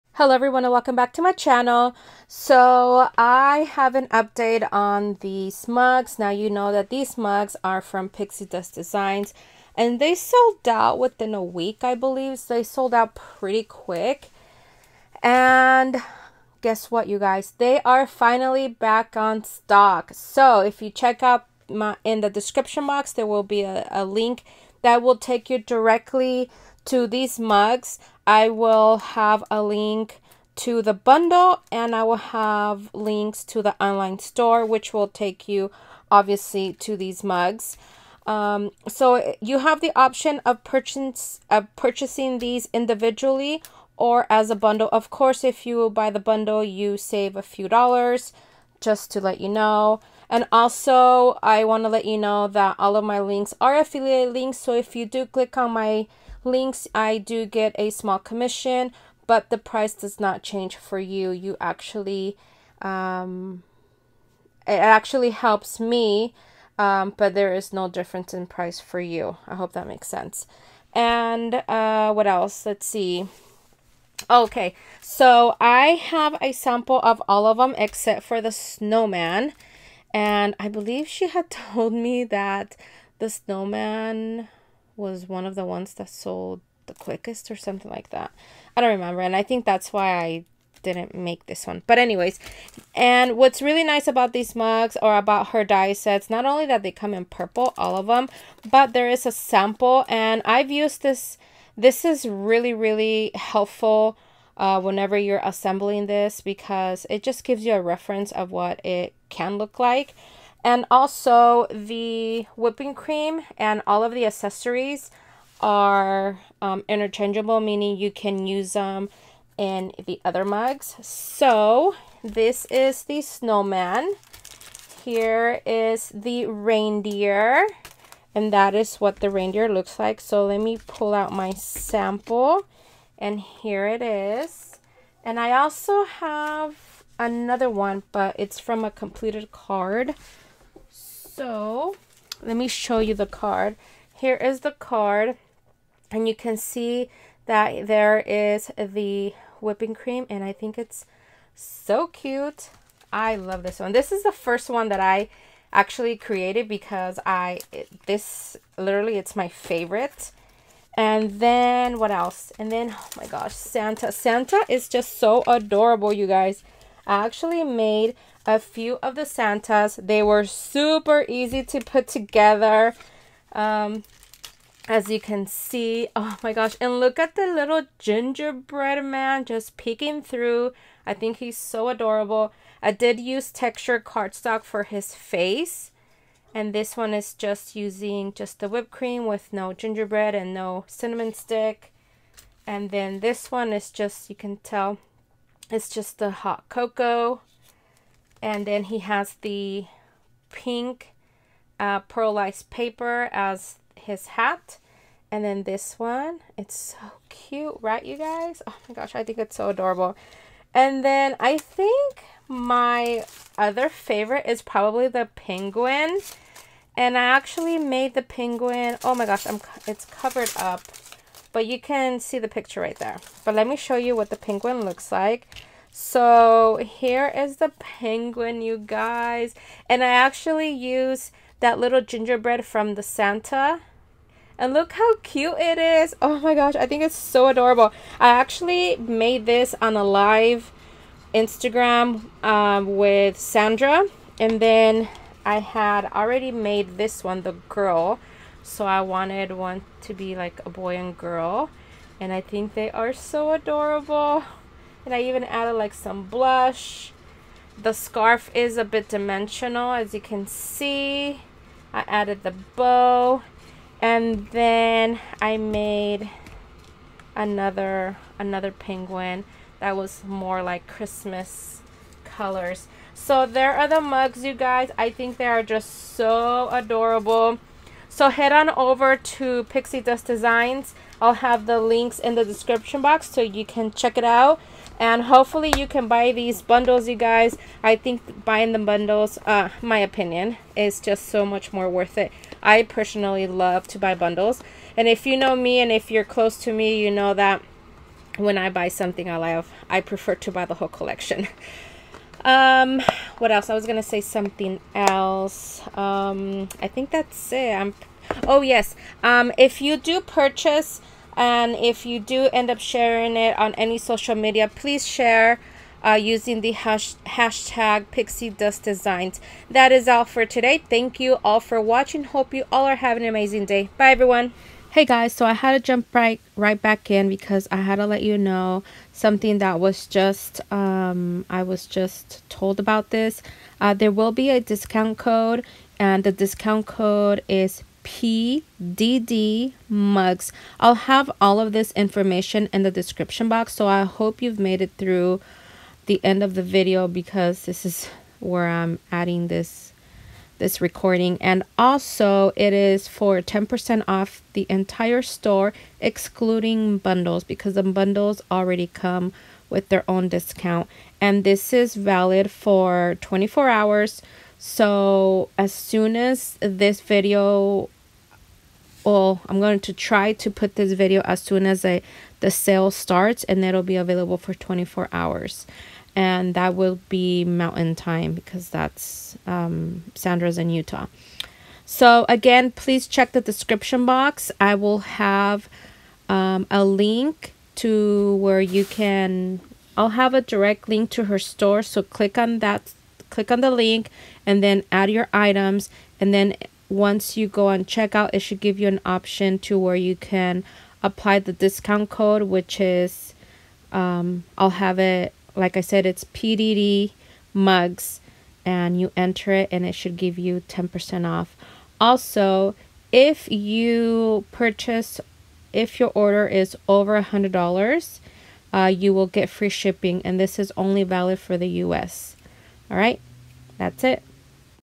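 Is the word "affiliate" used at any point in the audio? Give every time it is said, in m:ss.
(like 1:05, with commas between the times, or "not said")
0:53.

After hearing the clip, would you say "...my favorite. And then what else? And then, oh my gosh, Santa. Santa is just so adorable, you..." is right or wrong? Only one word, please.
right.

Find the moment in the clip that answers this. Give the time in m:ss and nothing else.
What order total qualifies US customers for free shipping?
6:57.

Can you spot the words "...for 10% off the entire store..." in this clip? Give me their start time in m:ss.
5:53.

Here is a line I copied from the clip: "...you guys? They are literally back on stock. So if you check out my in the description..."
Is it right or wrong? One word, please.
wrong.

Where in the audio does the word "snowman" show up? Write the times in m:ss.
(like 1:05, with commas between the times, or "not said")
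1:18, 1:23, 2:03.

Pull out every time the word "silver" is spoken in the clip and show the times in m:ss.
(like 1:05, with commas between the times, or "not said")
not said.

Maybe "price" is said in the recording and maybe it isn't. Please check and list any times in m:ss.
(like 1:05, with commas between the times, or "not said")
0:59, 1:08.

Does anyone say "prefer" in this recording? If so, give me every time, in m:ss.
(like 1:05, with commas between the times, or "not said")
5:00.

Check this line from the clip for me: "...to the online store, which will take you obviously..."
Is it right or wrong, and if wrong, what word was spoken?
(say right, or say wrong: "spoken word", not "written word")
right.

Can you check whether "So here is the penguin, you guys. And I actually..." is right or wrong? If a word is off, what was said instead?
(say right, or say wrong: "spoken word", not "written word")
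right.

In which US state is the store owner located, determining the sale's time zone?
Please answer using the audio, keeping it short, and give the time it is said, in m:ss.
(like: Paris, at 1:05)
Utah, at 6:20.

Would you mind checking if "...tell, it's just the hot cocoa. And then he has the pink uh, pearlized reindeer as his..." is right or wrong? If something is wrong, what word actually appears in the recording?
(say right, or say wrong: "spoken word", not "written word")
wrong: "paper", not "reindeer".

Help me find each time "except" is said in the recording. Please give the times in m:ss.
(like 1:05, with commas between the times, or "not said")
1:17.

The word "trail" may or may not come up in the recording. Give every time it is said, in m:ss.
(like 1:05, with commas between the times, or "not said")
not said.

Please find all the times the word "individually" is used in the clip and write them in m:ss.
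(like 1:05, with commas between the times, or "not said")
0:42.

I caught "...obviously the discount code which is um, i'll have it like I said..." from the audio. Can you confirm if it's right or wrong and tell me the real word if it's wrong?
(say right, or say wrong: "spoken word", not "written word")
wrong: "apply", not "obviously".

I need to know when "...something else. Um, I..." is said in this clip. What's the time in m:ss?
5:04.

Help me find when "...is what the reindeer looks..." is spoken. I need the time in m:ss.
2:08.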